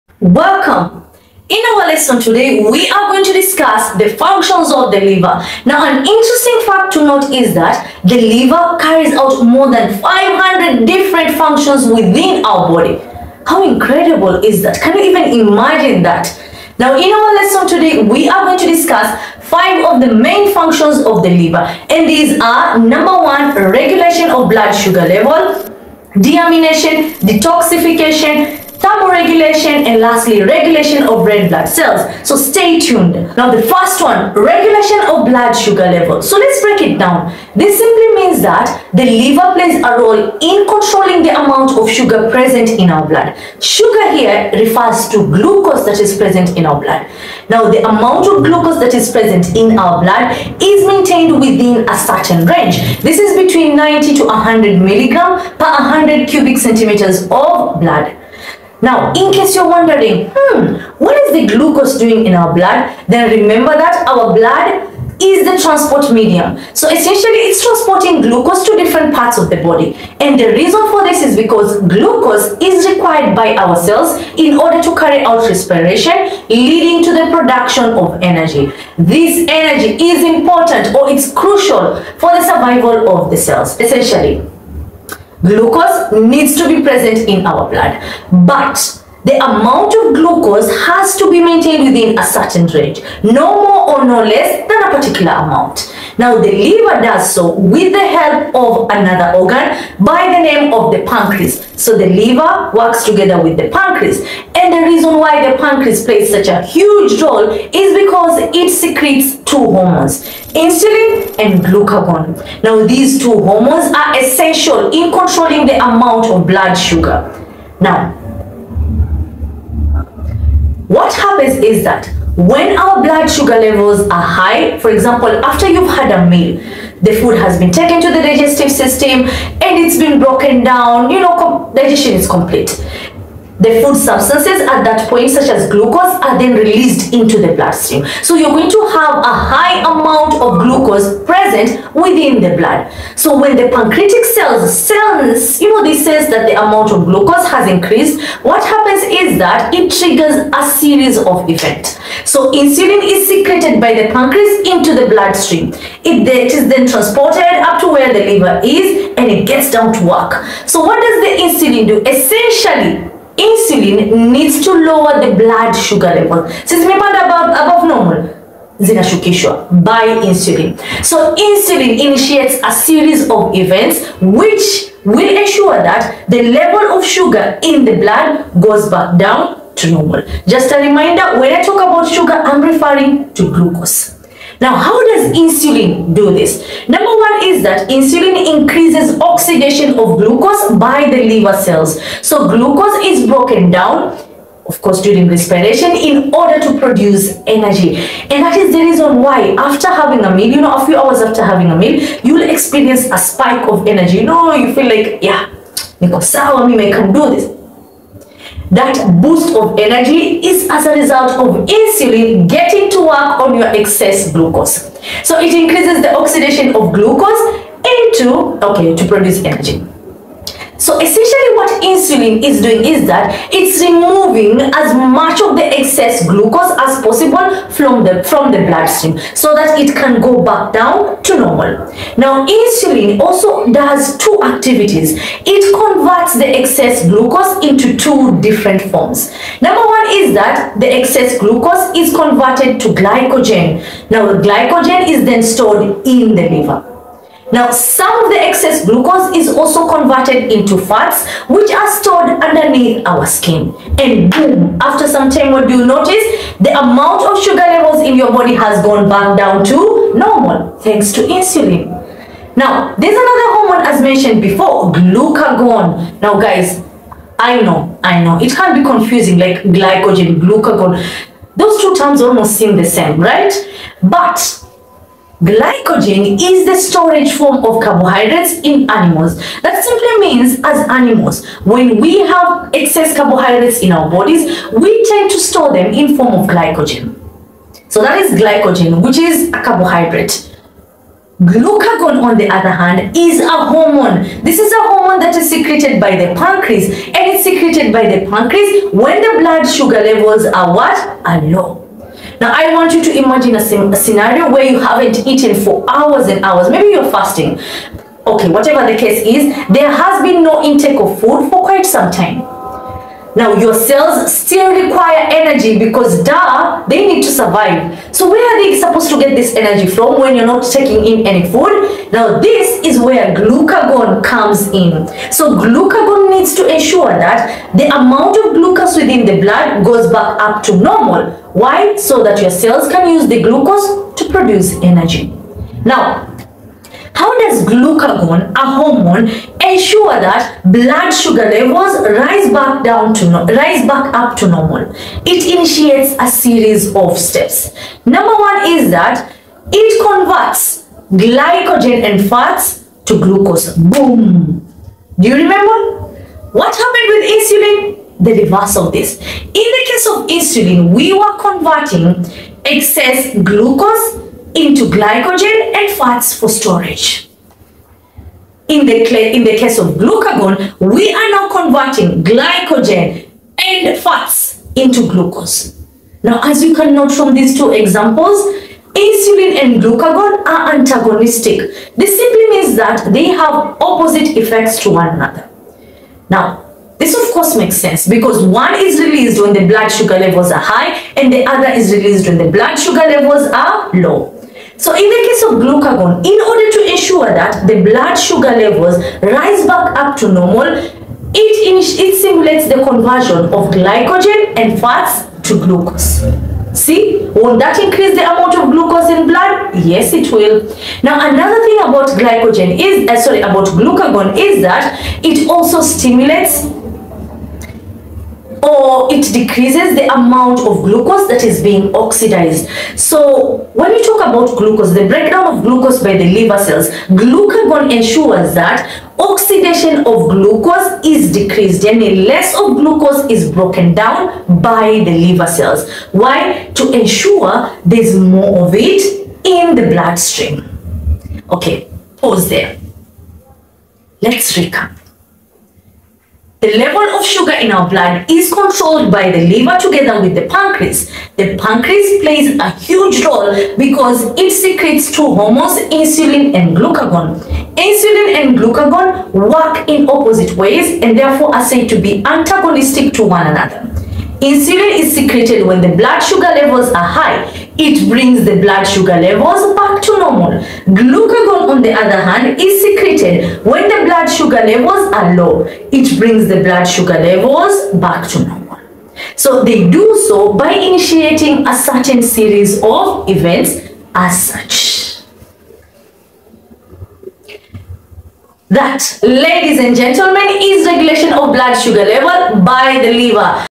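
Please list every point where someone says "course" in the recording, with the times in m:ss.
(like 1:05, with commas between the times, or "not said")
3:14, 6:27.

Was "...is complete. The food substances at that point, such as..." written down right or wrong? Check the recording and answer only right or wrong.
right.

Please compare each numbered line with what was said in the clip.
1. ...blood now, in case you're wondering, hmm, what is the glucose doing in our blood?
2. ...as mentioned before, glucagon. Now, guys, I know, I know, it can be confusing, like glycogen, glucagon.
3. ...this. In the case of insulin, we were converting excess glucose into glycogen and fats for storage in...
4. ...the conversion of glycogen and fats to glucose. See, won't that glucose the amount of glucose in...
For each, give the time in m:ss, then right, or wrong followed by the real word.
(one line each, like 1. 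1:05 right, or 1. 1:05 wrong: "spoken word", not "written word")
1. 0:57 right
2. 4:23 right
3. 5:58 right
4. 6:42 wrong: "increase", not "glucose".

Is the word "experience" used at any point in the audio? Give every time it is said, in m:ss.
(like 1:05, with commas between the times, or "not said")
3:22.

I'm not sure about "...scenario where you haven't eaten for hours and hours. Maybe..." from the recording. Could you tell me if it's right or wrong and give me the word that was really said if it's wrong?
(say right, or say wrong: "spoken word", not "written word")
right.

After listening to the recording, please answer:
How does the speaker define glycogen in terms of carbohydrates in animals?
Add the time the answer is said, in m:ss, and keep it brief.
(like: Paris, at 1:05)
storage form of carbohydrates, at 4:36.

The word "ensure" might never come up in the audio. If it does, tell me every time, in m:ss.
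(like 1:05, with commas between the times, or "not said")
2:55, 5:26, 5:39, 6:36, 7:07, 7:16.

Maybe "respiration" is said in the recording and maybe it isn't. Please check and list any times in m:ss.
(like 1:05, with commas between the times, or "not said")
1:15, 3:15.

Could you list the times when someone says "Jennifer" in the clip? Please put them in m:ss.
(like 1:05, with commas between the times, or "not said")
not said.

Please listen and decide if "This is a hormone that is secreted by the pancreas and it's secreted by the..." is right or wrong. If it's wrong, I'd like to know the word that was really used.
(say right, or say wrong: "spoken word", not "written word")
right.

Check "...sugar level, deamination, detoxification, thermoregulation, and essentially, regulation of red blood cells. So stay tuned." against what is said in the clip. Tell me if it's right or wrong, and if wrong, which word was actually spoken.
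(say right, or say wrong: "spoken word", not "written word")
wrong: "lastly", not "essentially".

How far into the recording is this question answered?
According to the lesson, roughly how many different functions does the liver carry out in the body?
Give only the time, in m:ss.
0:09.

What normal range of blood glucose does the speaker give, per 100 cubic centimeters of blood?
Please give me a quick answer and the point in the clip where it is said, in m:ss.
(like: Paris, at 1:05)
90 to 100 milligrams, at 0:53.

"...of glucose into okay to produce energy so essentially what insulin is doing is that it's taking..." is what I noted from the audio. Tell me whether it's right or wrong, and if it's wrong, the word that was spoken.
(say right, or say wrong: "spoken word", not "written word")
wrong: "removing", not "taking".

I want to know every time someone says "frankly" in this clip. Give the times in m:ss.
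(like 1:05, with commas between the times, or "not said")
not said.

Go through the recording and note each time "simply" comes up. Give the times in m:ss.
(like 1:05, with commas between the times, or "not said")
0:37, 4:39, 6:22.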